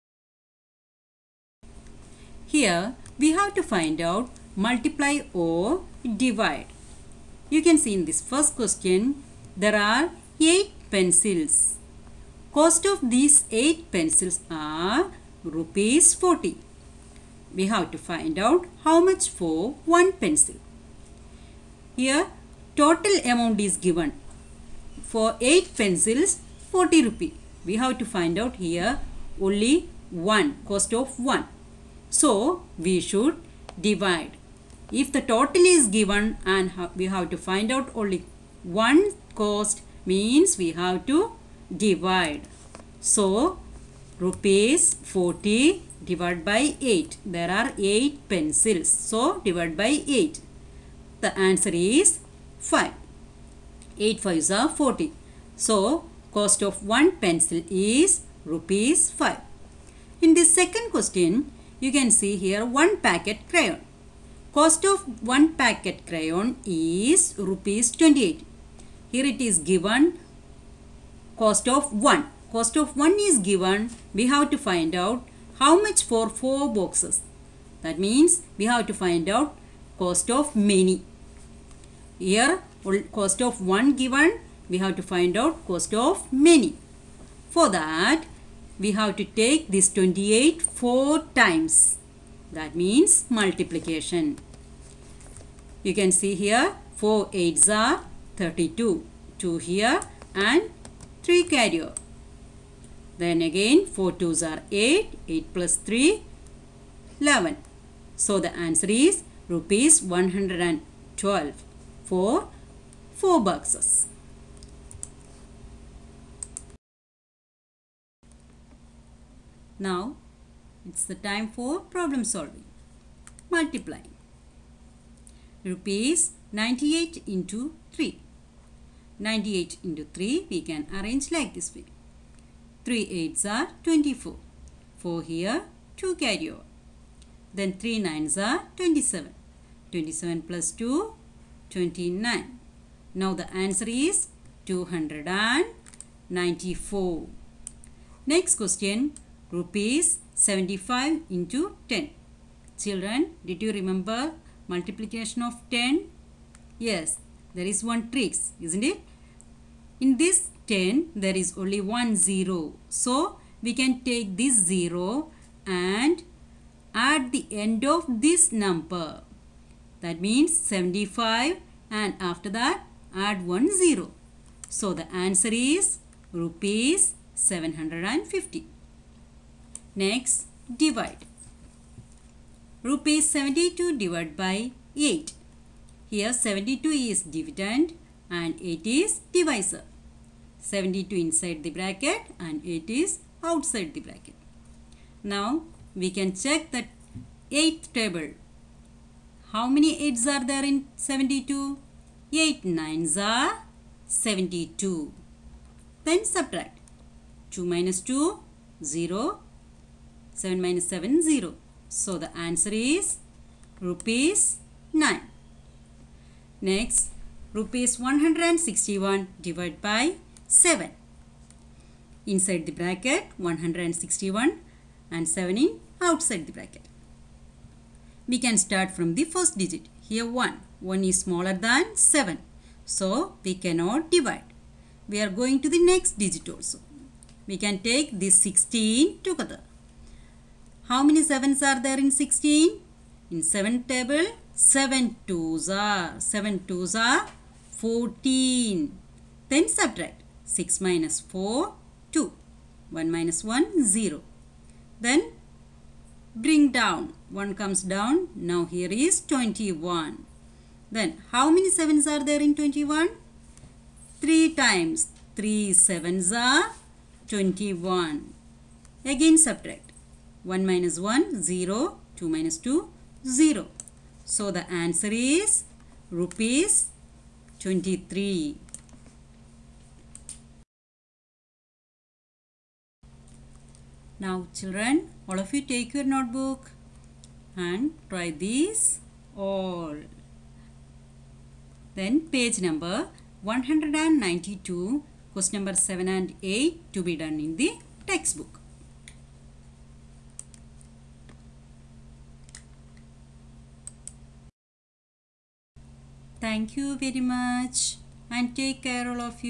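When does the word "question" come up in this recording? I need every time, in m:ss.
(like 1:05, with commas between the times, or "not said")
0:08, 1:00, 2:28, 4:55.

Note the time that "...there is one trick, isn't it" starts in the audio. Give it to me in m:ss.
2:37.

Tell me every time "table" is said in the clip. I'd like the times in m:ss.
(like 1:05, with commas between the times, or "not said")
3:17, 4:03.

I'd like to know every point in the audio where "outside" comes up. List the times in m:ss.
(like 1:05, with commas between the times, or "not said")
3:13, 3:46.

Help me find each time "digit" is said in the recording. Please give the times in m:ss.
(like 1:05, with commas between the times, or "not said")
3:49, 3:56.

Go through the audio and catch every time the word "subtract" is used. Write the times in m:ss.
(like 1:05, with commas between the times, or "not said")
3:26, 4:09, 4:29.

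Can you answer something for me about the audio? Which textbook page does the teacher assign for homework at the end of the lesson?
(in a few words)
192.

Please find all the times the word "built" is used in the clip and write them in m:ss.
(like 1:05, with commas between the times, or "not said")
not said.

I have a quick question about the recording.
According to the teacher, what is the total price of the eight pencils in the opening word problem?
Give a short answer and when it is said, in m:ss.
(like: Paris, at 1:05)
Rs 40, at 0:12.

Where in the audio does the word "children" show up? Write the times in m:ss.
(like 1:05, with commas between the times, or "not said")
2:32, 4:44.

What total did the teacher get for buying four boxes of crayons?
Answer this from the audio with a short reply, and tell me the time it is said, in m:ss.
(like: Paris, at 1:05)
Rs 112, at 1:49.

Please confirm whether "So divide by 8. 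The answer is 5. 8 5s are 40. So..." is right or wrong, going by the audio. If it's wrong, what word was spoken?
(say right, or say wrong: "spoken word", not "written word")
right.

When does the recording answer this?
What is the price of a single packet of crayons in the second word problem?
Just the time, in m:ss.
1:04.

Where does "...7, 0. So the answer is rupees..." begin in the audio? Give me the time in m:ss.
3:30.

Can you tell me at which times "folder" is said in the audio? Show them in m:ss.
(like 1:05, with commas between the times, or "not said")
not said.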